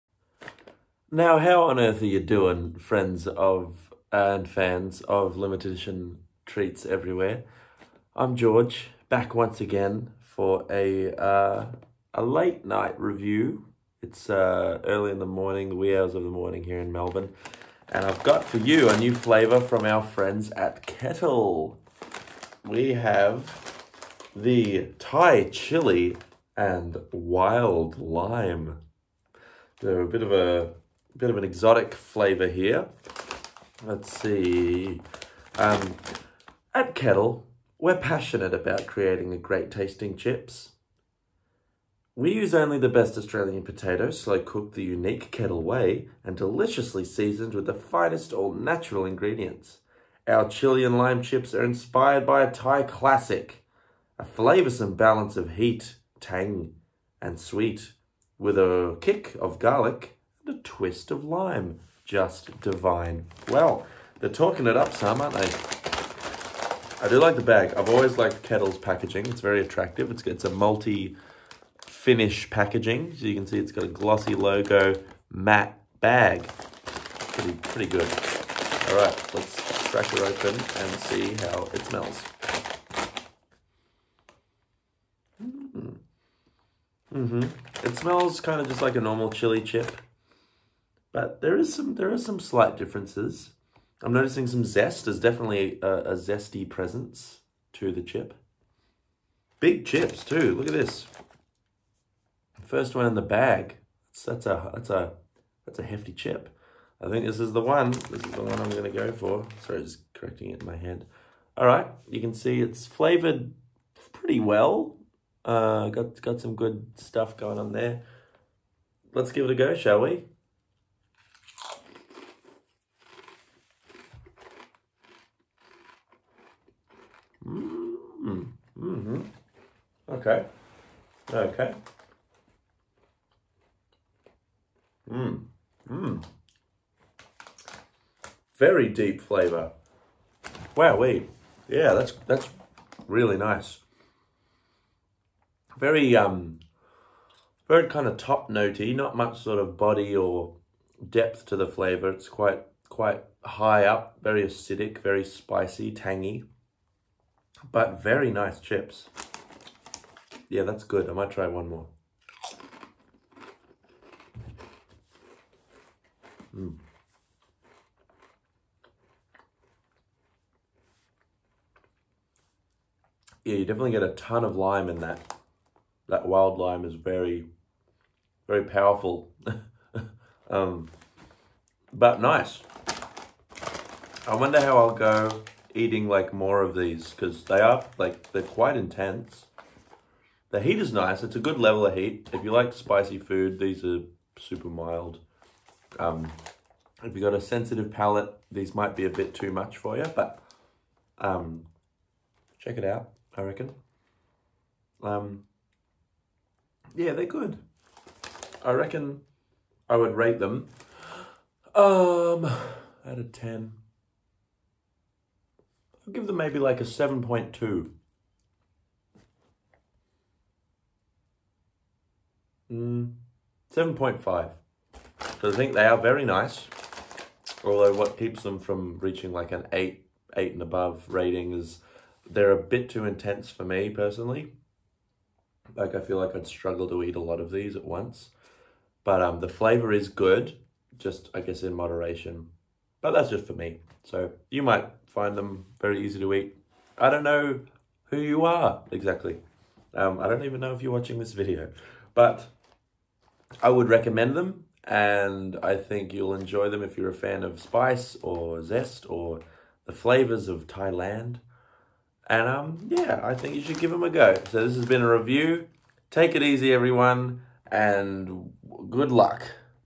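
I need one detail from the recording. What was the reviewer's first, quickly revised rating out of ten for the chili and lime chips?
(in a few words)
7.2.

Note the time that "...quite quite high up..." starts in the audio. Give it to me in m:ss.
2:32.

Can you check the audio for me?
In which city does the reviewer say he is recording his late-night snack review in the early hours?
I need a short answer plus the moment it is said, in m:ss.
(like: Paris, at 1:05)
Melbourne, at 0:16.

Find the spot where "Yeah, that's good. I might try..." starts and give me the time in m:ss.
2:40.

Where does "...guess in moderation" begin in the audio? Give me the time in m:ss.
4:01.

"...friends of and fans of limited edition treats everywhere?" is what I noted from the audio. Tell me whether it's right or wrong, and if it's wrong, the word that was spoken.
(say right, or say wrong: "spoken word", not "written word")
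right.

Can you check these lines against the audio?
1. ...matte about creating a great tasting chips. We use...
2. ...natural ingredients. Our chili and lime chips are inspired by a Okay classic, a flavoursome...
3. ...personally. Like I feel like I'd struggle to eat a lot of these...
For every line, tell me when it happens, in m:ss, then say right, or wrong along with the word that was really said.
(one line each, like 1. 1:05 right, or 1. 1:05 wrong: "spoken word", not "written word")
1. 0:37 wrong: "passionate", not "matte"
2. 0:48 wrong: "Thai", not "Okay"
3. 3:53 right.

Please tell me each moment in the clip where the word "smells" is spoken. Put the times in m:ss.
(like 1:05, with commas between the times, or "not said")
1:21, 1:27.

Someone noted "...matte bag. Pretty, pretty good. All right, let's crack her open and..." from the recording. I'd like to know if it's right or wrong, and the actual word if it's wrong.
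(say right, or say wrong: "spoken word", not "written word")
right.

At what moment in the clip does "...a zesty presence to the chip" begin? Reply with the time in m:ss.
1:35.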